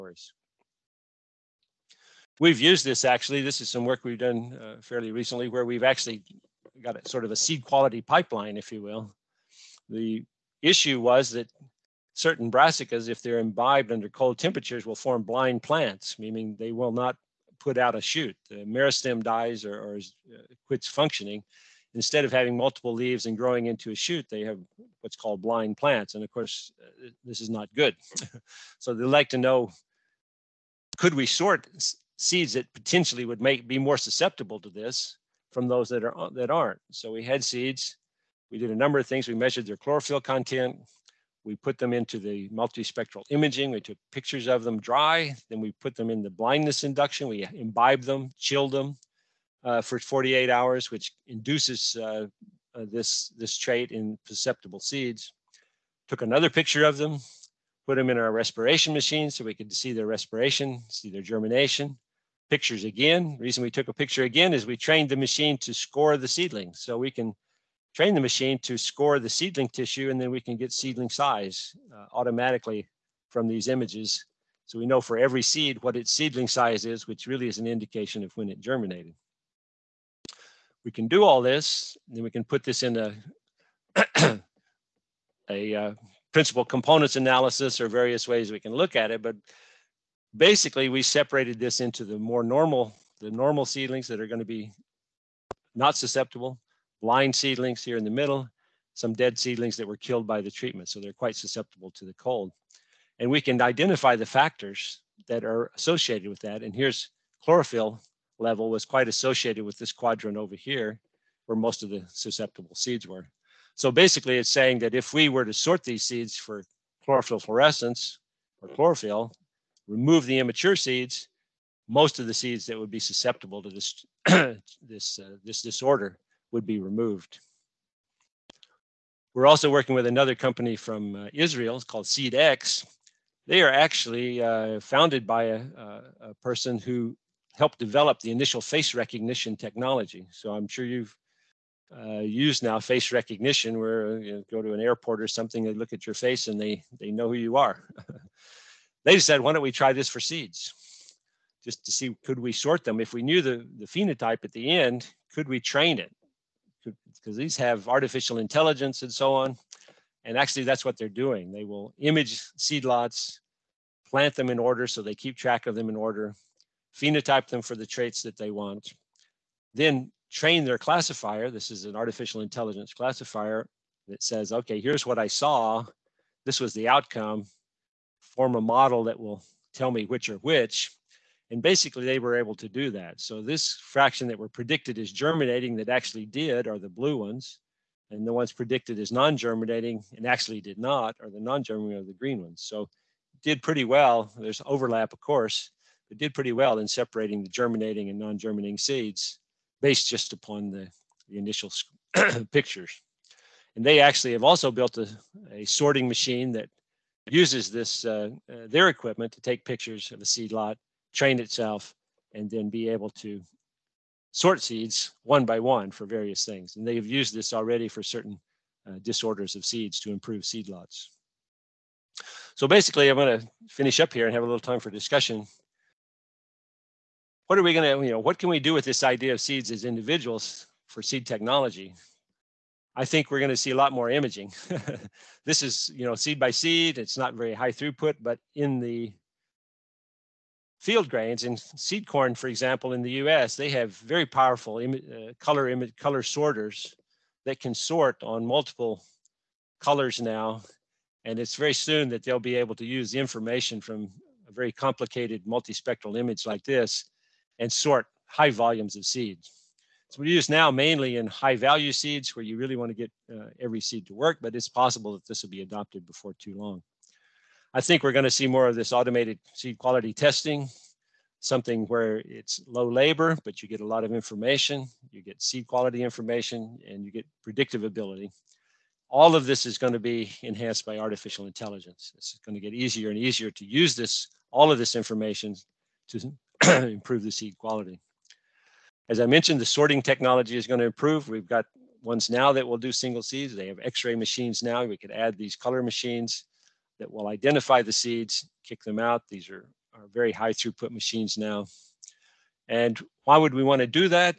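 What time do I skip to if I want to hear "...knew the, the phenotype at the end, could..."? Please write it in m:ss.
2:33.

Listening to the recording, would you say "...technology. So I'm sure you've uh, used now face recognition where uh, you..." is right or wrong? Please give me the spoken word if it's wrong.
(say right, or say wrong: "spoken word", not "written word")
right.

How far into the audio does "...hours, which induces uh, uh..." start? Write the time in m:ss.
0:50.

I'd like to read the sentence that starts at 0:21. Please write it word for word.
Instead of having multiple leaves and growing into a shoot, they have what's called blind plants.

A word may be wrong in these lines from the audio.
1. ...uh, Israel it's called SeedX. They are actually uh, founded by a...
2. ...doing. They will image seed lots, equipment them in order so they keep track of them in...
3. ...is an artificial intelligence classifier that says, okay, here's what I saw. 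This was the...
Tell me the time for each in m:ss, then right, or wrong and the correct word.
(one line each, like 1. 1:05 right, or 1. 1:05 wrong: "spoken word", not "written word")
1. 2:11 right
2. 2:41 wrong: "plant", not "equipment"
3. 2:51 right.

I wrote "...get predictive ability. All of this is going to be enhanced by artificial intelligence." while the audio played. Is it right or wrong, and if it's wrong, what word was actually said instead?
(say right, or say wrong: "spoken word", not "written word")
right.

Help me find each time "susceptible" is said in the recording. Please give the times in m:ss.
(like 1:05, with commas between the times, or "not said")
0:33, 0:54, 1:35, 1:41, 1:52, 2:02.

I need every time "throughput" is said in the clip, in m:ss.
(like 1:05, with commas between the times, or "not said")
3:57, 5:00.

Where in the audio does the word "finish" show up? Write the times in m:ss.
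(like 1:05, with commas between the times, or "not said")
3:43.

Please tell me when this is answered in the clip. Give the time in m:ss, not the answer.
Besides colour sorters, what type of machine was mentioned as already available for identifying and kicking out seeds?
4:53.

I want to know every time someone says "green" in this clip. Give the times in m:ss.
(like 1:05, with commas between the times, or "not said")
3:12.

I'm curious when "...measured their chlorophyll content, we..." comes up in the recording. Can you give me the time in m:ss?
0:39.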